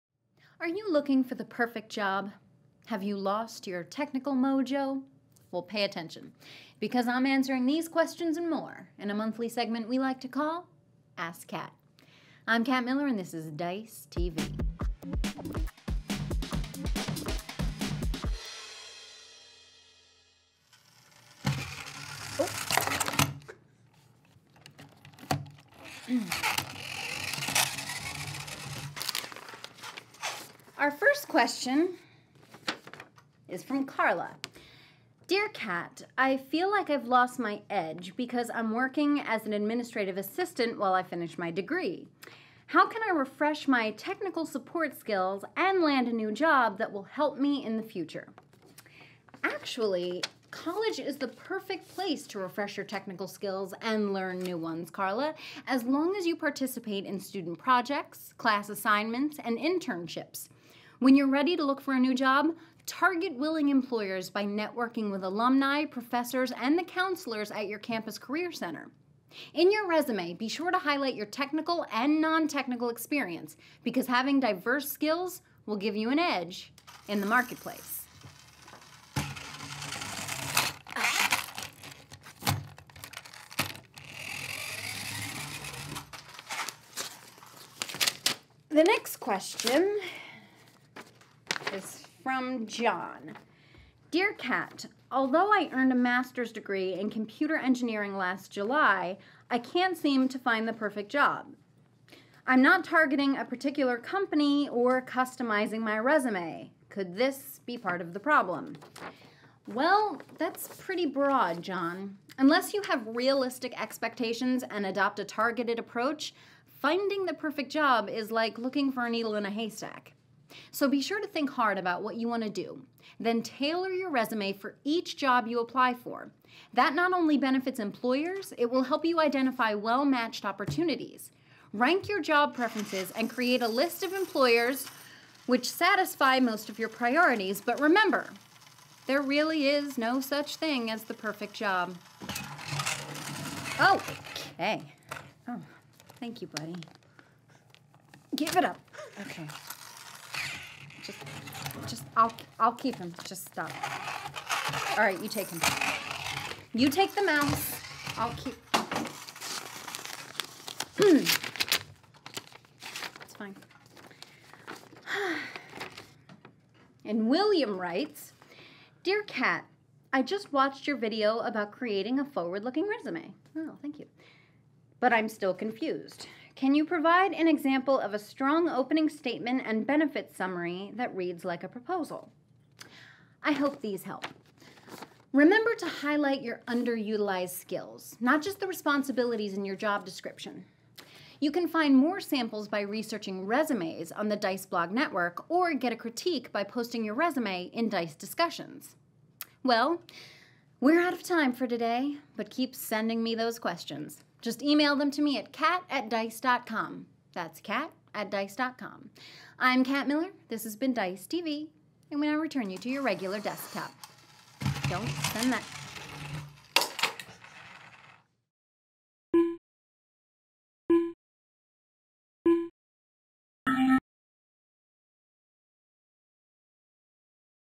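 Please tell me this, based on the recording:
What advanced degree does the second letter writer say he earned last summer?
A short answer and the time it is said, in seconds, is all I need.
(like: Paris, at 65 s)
master's degree in computer engineering, at 95 s.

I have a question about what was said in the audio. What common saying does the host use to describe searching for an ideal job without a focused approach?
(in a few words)
needle in a haystack.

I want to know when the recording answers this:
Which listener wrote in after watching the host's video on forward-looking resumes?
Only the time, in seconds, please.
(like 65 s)
167 s.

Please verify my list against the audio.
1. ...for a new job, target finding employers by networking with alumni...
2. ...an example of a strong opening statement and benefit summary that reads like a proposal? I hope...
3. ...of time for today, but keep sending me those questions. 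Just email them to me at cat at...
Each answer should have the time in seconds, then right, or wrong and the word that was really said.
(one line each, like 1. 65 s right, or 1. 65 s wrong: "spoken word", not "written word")
1. 61 s wrong: "willing", not "finding"
2. 177 s right
3. 201 s right.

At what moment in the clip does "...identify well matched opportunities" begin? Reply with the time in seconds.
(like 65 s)
129 s.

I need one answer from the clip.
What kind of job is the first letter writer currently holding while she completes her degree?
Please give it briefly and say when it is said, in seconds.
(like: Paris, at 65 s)
administrative assistant, at 39 s.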